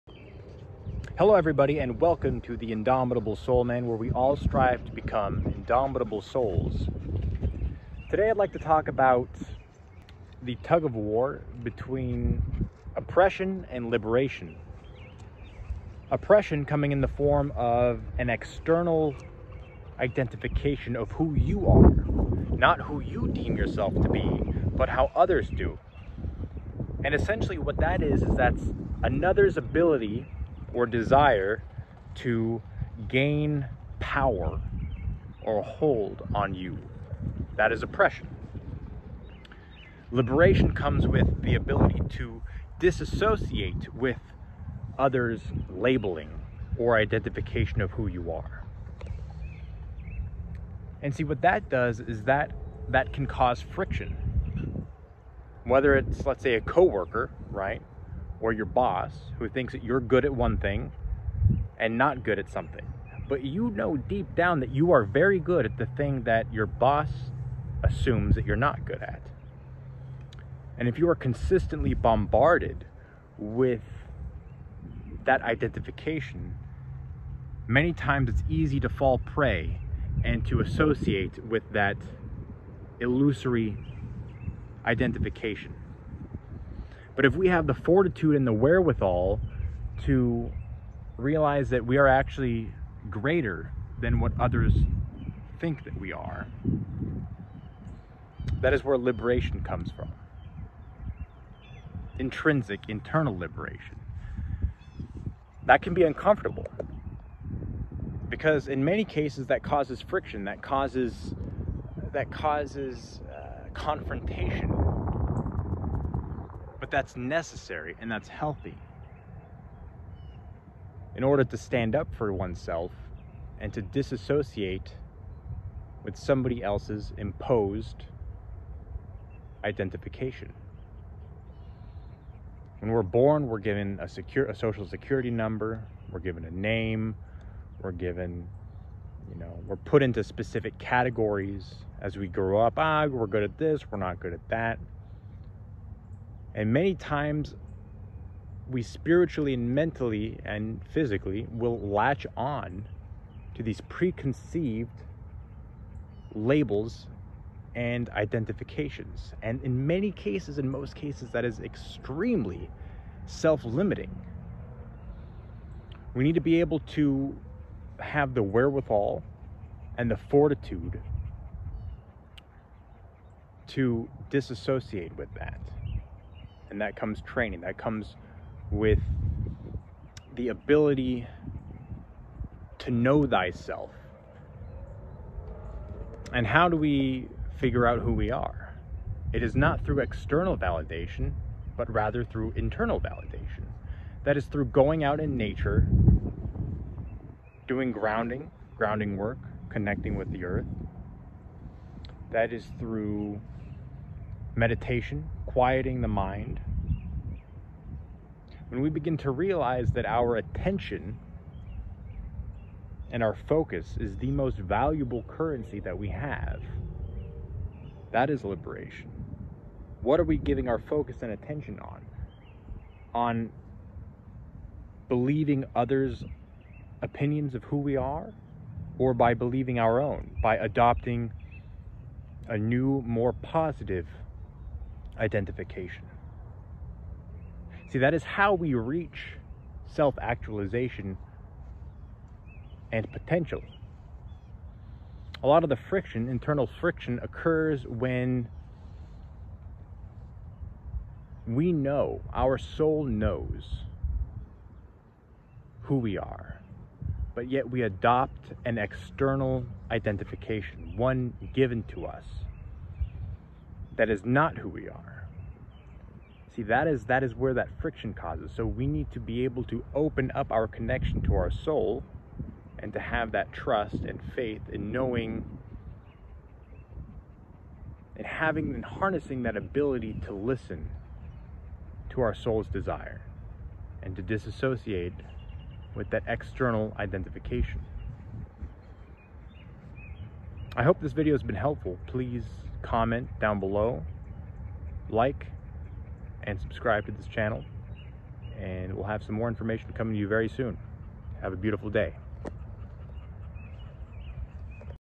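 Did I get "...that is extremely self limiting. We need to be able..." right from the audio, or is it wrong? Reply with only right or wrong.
right.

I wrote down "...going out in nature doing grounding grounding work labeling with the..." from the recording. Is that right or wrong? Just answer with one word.
wrong.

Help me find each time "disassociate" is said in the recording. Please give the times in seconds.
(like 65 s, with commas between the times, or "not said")
42 s, 123 s, 174 s, 284 s.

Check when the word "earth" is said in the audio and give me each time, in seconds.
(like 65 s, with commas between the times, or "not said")
200 s.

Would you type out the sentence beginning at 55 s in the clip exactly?
Whether it's let's say a coworker, right?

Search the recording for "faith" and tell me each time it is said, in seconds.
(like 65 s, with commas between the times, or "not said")
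274 s.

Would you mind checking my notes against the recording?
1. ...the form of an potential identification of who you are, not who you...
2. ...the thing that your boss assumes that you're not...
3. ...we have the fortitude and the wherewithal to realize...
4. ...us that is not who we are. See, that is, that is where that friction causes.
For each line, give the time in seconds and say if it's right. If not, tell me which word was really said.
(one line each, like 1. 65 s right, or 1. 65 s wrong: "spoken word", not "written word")
1. 17 s wrong: "external", not "potential"
2. 65 s right
3. 87 s right
4. 262 s right.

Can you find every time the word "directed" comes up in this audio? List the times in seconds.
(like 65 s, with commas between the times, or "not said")
not said.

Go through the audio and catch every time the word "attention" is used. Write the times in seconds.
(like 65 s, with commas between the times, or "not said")
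210 s, 221 s.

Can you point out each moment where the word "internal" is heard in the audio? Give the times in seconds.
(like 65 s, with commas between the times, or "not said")
102 s, 192 s, 246 s.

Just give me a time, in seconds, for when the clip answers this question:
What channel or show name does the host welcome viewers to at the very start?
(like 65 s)
2 s.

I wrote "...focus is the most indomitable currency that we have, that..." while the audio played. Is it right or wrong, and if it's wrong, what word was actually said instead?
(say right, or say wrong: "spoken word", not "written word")
wrong: "valuable", not "indomitable".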